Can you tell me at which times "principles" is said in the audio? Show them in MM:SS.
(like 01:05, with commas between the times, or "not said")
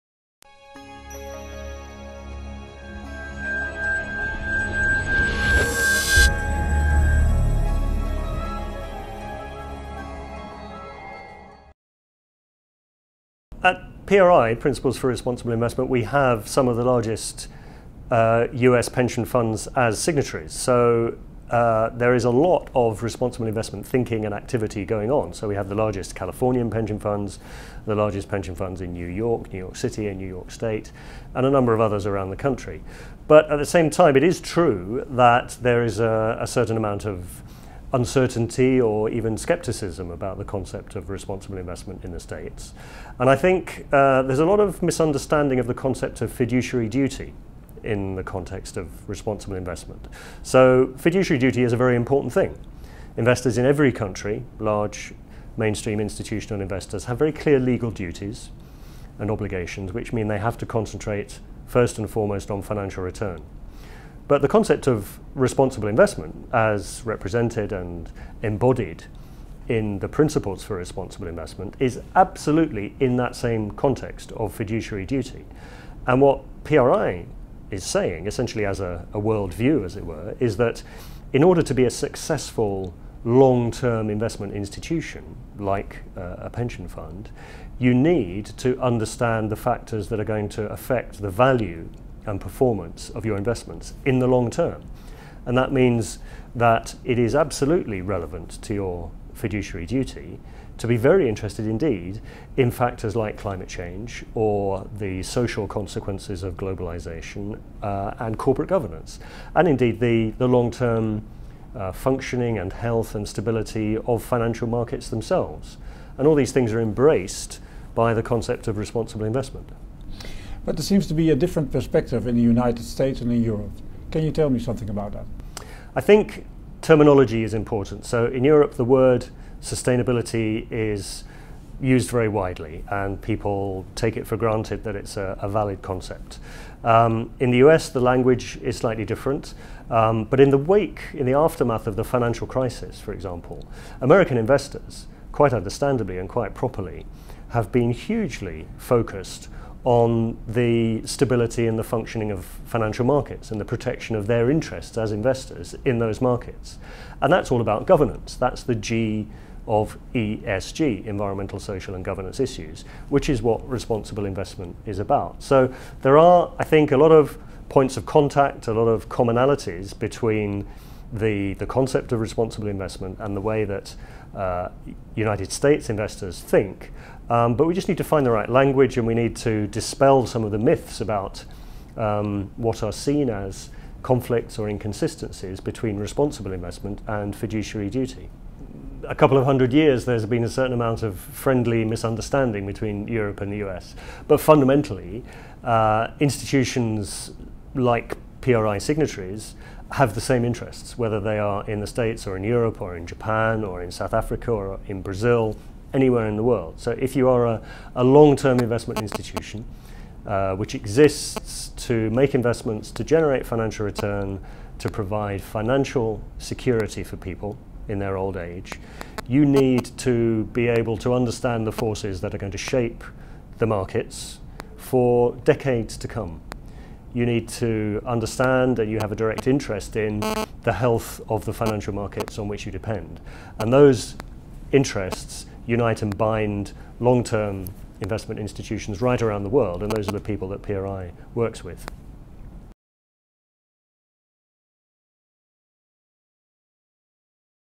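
00:14, 01:10.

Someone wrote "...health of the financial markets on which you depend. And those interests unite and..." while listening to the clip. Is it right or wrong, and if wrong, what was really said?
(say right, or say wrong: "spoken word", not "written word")
right.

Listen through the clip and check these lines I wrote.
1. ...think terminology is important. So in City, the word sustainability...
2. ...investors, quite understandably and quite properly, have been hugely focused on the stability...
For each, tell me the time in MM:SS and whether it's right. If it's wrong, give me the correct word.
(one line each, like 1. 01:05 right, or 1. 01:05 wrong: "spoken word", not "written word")
1. 02:06 wrong: "Europe", not "City"
2. 02:24 right.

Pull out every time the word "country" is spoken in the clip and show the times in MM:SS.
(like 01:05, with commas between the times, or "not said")
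00:32, 00:53.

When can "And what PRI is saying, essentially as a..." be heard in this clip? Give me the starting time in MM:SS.
01:16.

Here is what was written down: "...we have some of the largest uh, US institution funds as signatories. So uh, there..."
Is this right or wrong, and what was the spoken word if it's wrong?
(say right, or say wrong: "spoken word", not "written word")
wrong: "pension", not "institution".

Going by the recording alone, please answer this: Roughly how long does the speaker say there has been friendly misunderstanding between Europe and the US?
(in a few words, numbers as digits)
A couple of hundred years.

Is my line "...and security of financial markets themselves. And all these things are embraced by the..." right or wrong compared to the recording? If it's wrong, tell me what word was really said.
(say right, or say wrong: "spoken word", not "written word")
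wrong: "stability", not "security".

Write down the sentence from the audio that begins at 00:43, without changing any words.
And I think uh, there's a lot of misunderstanding of the concept of fiduciary duty in the context of responsible investment.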